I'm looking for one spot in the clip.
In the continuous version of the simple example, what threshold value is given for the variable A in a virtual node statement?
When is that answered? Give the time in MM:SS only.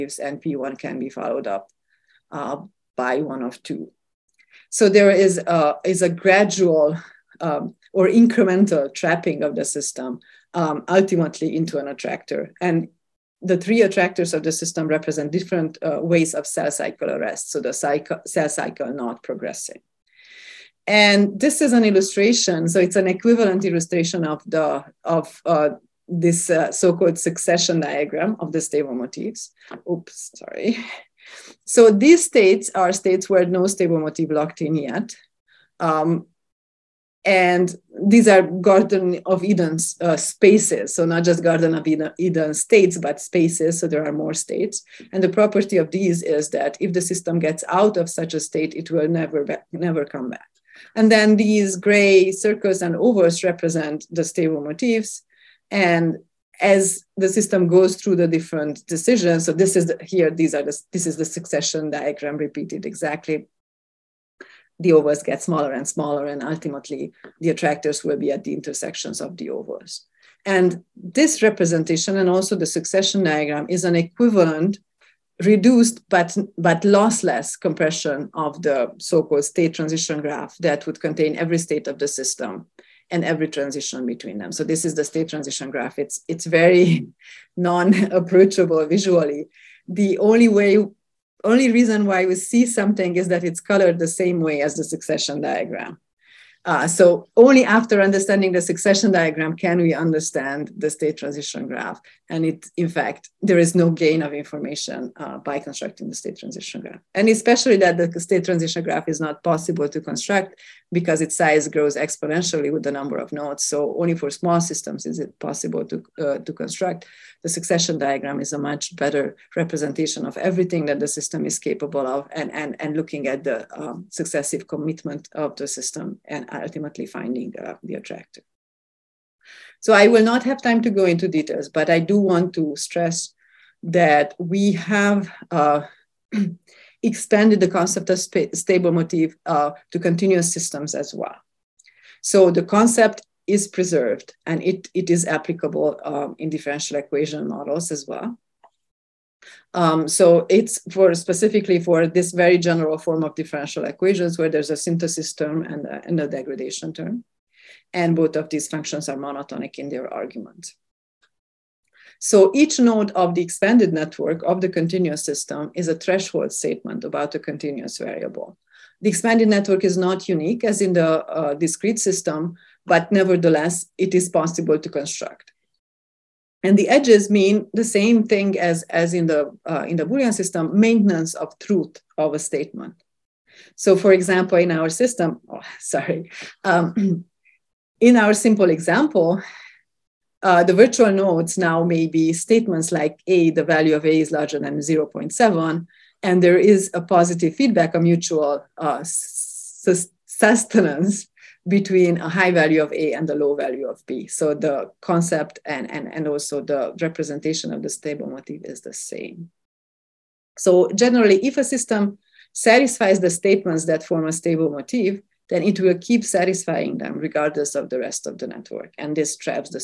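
03:14.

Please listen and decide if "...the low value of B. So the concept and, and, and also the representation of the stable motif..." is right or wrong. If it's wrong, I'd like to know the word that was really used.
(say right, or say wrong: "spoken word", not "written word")
right.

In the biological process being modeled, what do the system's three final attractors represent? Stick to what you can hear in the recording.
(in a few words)
cell cycle arrest.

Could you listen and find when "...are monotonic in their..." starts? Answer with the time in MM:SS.
02:39.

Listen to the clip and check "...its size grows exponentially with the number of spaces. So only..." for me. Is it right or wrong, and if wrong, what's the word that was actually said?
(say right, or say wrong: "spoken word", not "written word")
wrong: "nodes", not "spaces".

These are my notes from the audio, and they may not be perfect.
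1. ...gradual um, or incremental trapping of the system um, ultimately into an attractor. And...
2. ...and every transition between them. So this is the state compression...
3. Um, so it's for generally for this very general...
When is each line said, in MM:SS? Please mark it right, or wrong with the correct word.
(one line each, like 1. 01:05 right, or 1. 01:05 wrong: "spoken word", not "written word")
1. 00:06 right
2. 01:23 wrong: "transition", not "compression"
3. 02:29 wrong: "specifically", not "generally".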